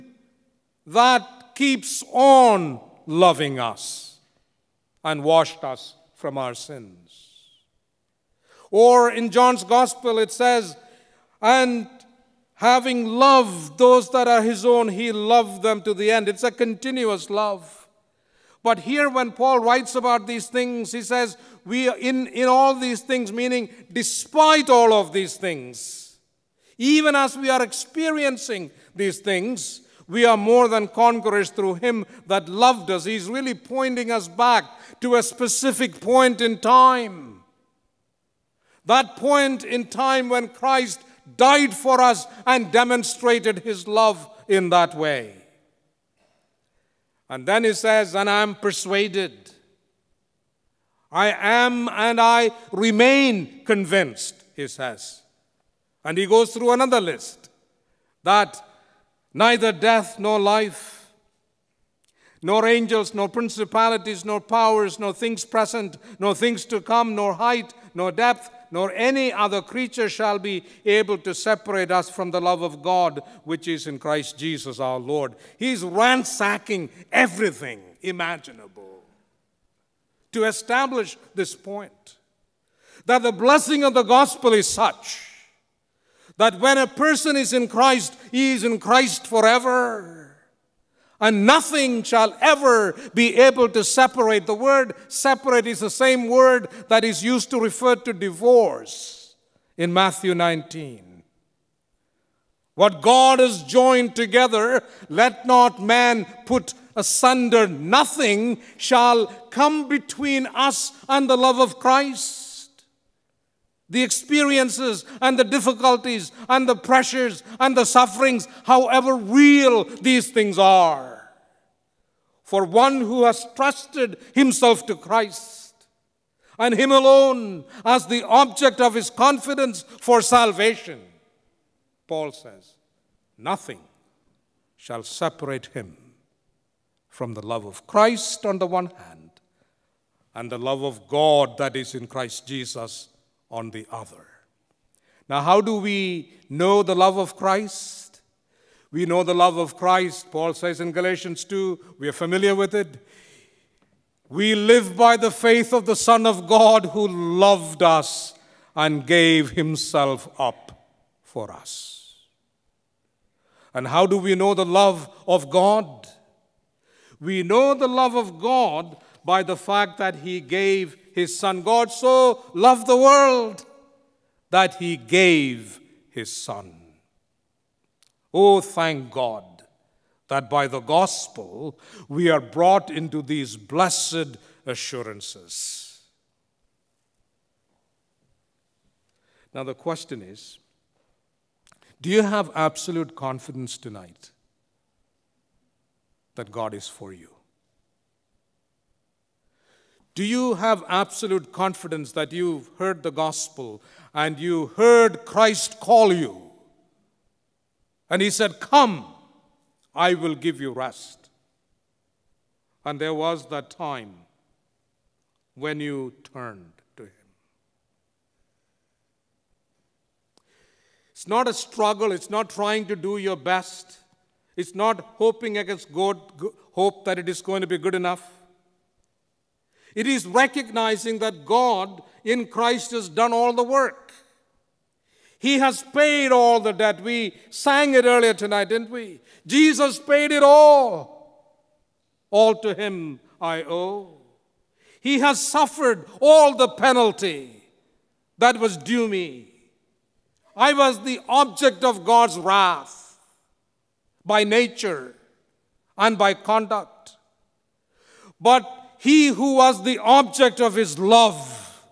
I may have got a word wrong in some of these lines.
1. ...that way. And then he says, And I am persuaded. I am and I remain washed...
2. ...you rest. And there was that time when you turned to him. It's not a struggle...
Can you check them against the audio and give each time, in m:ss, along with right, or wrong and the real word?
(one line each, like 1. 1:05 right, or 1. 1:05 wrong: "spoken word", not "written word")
1. 0:44 wrong: "convinced", not "washed"
2. 3:30 right.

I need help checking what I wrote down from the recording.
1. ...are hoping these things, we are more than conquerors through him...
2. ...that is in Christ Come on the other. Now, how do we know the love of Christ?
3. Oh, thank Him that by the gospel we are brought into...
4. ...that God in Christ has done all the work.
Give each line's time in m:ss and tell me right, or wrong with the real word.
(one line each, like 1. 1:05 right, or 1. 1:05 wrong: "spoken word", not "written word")
1. 0:27 wrong: "experiencing", not "hoping"
2. 2:21 wrong: "Jesus", not "Come"
3. 2:58 wrong: "God", not "Him"
4. 3:51 right.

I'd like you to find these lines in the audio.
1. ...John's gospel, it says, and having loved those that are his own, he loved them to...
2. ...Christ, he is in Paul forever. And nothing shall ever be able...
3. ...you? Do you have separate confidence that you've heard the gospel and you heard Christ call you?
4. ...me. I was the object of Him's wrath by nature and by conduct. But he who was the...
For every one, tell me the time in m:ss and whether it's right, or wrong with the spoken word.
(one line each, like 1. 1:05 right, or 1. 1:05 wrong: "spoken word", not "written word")
1. 0:09 right
2. 1:27 wrong: "Christ", not "Paul"
3. 3:17 wrong: "absolute", not "separate"
4. 4:09 wrong: "God", not "Him".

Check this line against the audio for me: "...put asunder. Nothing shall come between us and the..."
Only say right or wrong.
right.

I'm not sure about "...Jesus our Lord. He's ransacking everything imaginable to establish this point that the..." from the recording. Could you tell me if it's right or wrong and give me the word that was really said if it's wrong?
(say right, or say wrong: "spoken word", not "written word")
right.